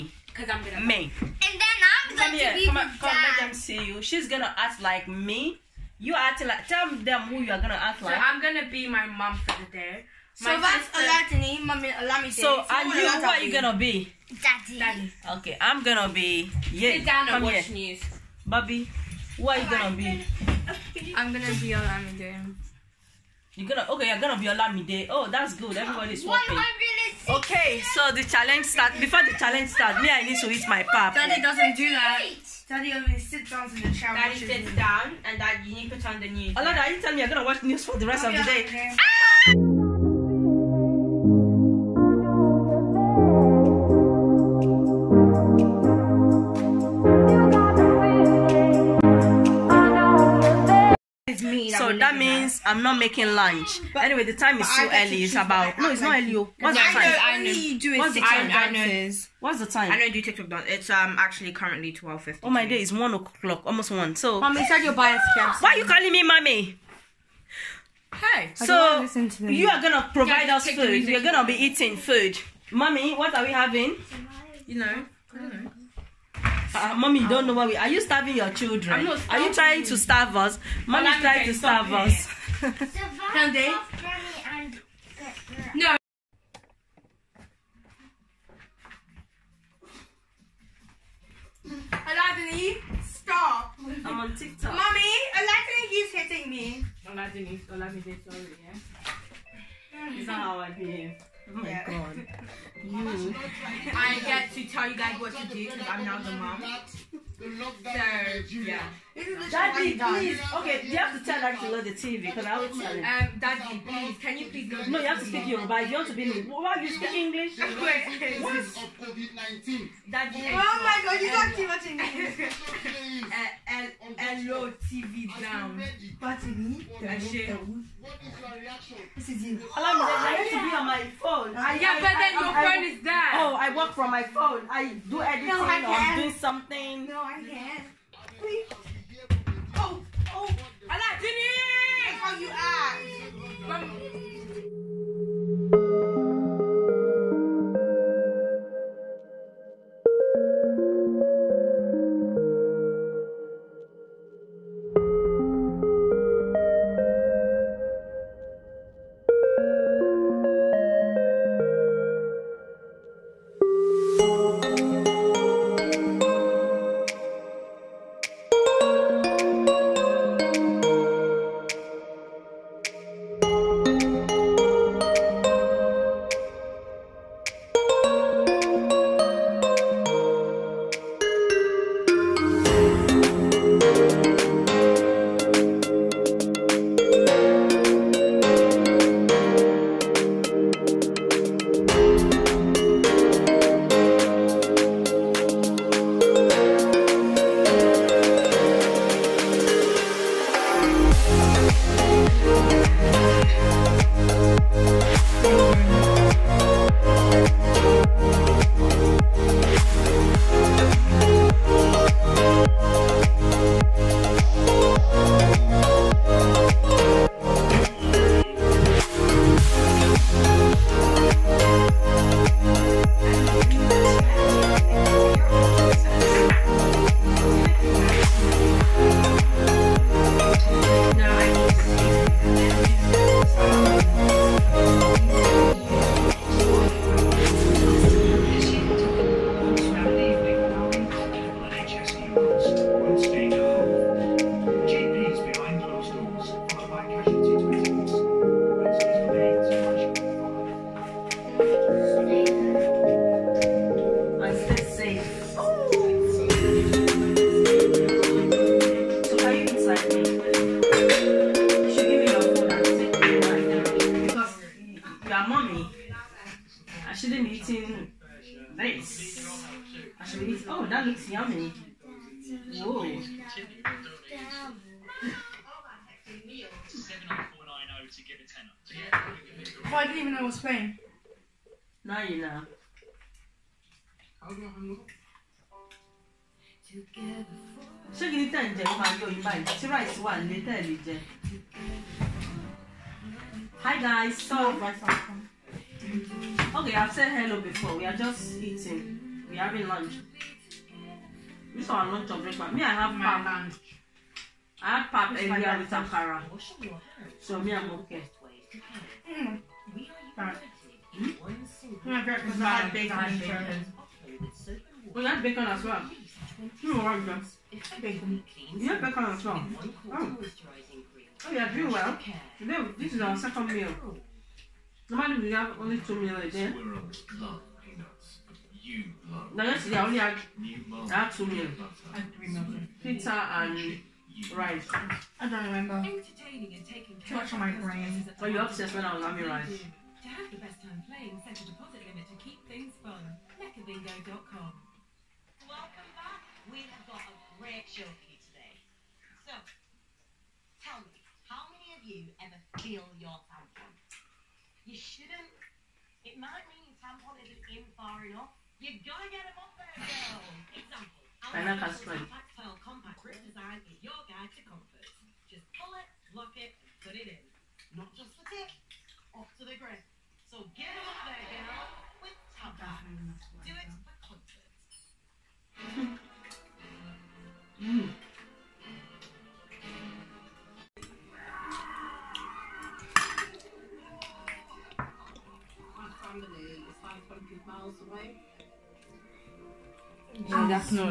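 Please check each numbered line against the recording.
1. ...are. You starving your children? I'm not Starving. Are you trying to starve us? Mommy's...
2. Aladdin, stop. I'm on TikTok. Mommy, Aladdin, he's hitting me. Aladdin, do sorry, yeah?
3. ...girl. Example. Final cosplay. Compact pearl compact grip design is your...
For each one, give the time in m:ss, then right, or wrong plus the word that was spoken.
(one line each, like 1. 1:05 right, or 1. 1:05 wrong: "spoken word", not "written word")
1. 1:17 right
2. 1:31 right
3. 6:00 right.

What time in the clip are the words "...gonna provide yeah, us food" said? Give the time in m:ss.
1:09.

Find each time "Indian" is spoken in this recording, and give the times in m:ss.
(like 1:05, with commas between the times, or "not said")
not said.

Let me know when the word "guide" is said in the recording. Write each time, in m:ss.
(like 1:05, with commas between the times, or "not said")
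6:04.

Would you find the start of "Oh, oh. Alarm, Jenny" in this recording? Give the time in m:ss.
2:19.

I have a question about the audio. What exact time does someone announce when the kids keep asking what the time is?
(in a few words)
12:50.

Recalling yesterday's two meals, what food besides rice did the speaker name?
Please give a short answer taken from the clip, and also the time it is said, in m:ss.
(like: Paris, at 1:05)
Pizza, at 5:32.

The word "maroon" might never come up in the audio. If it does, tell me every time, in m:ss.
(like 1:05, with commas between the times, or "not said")
not said.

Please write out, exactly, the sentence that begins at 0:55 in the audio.
It's about no, it's not early.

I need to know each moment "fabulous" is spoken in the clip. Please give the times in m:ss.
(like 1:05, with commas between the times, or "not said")
not said.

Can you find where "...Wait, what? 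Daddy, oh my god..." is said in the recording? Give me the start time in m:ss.
1:57.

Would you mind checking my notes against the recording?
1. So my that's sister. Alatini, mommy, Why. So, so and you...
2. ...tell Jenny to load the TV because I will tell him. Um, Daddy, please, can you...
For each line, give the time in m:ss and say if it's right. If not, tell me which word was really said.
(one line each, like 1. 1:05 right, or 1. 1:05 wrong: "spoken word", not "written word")
1. 0:10 wrong: "Olamide", not "Why"
2. 1:51 wrong: "Daddy", not "Jenny".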